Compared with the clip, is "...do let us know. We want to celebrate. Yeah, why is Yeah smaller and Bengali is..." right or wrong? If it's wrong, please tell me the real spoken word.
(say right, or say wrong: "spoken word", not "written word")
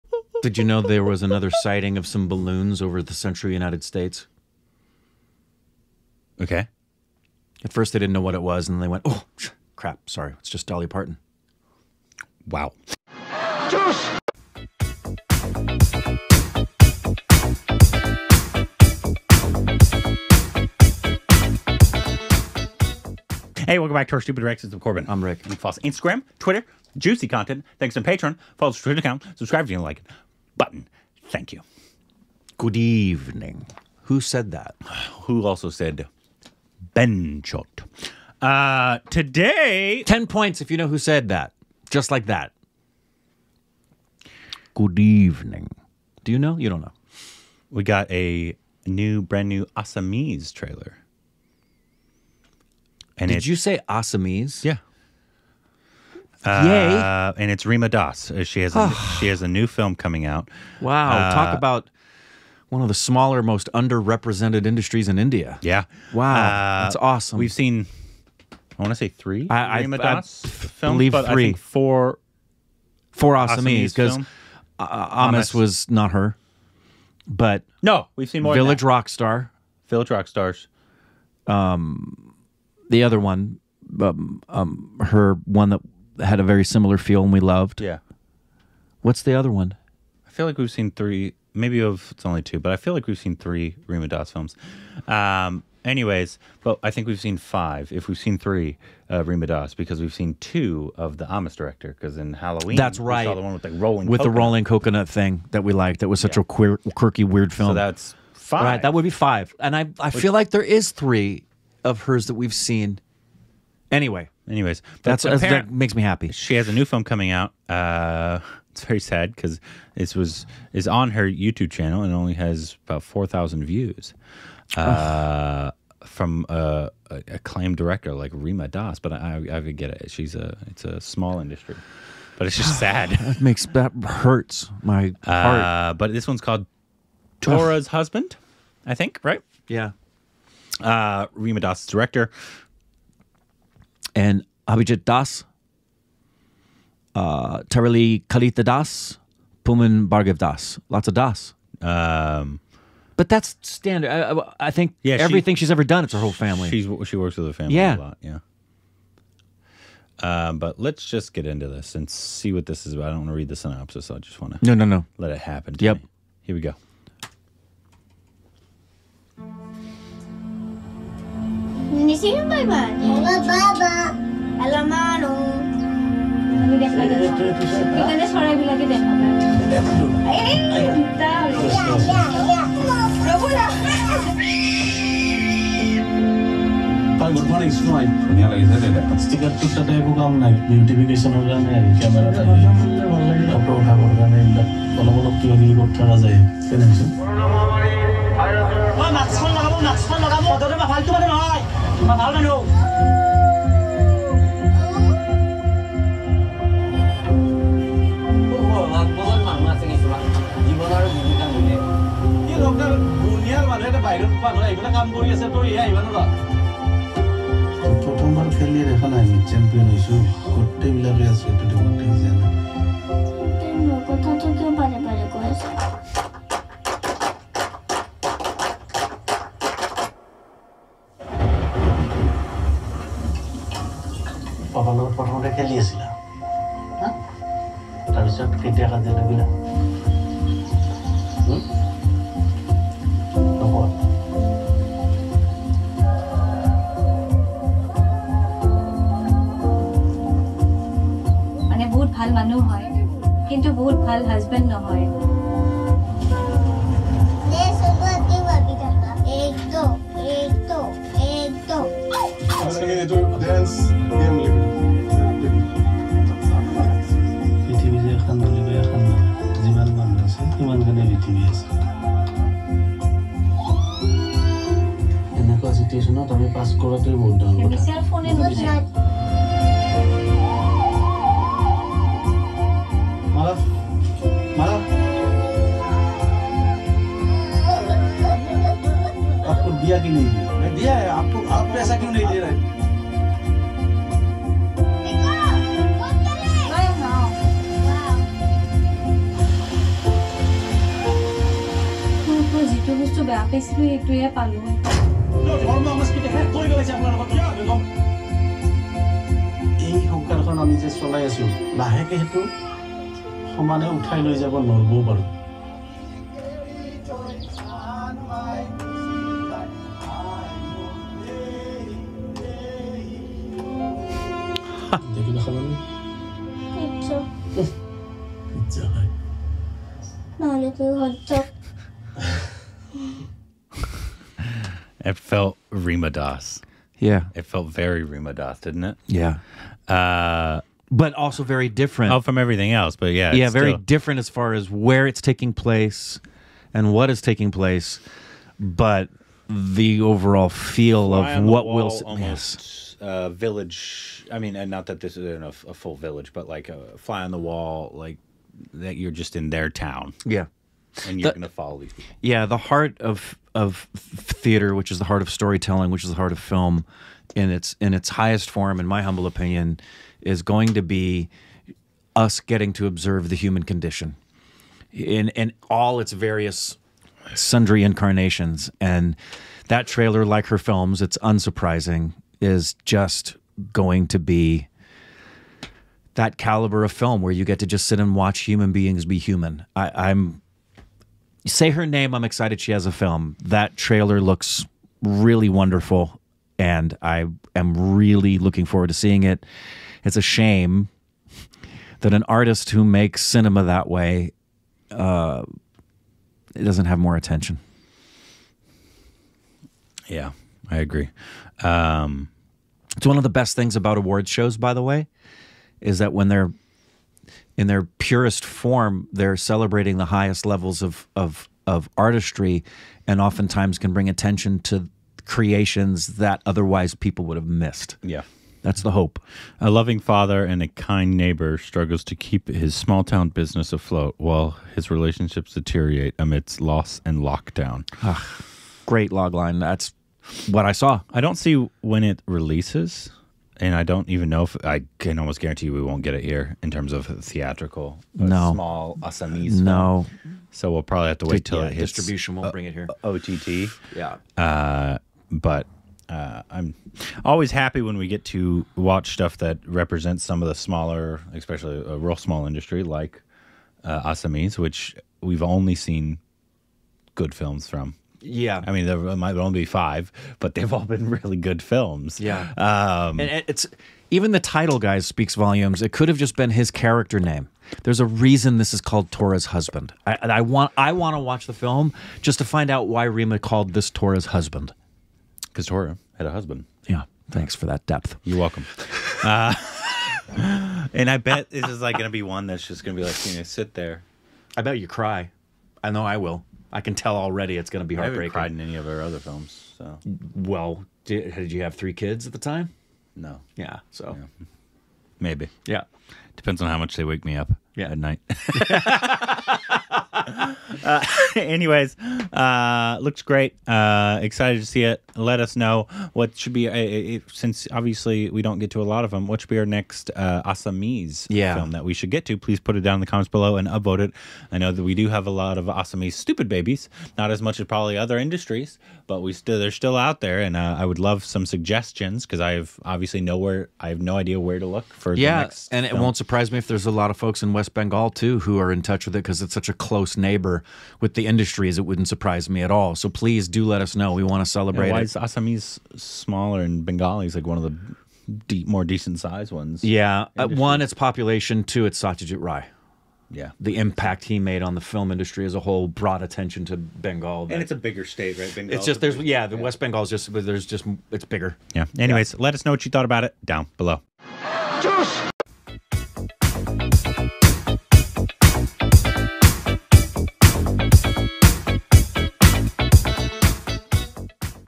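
wrong: "Assamese", not "Yeah".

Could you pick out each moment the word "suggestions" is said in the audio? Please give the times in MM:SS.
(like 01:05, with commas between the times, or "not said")
08:51.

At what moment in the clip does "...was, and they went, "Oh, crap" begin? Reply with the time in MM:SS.
00:08.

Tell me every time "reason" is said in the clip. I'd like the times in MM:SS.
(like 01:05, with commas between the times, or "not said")
07:58.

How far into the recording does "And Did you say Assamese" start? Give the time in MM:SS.
00:53.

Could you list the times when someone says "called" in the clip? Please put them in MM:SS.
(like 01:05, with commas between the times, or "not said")
02:16, 07:58, 08:03.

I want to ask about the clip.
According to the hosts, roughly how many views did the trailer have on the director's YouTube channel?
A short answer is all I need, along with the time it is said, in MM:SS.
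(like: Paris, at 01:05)
4,000, at 02:03.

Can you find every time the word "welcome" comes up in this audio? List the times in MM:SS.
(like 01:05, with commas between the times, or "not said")
00:23, 08:08.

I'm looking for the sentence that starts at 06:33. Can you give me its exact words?
That trailer looks really wonderful, and I am really looking forward to seeing it.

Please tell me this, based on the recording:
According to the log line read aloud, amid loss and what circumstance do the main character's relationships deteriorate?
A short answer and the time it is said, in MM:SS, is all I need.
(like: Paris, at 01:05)
lockdown, at 07:17.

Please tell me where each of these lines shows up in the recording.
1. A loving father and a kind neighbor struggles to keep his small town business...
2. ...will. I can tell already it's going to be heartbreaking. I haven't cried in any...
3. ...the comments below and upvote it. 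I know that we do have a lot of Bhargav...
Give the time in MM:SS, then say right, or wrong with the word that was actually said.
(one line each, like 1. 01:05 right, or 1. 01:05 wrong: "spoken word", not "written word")
1. 07:09 right
2. 08:16 right
3. 08:43 wrong: "Assamese", not "Bhargav".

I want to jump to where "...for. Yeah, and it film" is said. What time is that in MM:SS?
08:54.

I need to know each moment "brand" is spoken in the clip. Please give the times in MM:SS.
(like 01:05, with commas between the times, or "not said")
00:49.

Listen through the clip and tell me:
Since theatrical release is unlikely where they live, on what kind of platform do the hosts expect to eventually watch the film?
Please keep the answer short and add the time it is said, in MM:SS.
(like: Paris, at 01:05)
OTT, at 07:33.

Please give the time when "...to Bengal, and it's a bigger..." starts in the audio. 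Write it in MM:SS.
09:16.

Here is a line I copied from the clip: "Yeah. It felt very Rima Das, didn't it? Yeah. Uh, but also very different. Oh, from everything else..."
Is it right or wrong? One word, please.
right.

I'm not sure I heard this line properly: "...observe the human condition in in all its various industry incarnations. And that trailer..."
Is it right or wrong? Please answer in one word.
wrong.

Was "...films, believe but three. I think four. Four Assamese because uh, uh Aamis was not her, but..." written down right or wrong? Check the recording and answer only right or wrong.
right.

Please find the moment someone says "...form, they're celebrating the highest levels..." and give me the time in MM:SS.
06:58.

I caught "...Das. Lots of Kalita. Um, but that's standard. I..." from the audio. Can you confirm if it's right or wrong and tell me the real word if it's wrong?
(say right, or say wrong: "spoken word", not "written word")
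wrong: "Das", not "Kalita".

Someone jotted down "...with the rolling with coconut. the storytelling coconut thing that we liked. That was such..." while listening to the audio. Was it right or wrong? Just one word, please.
wrong.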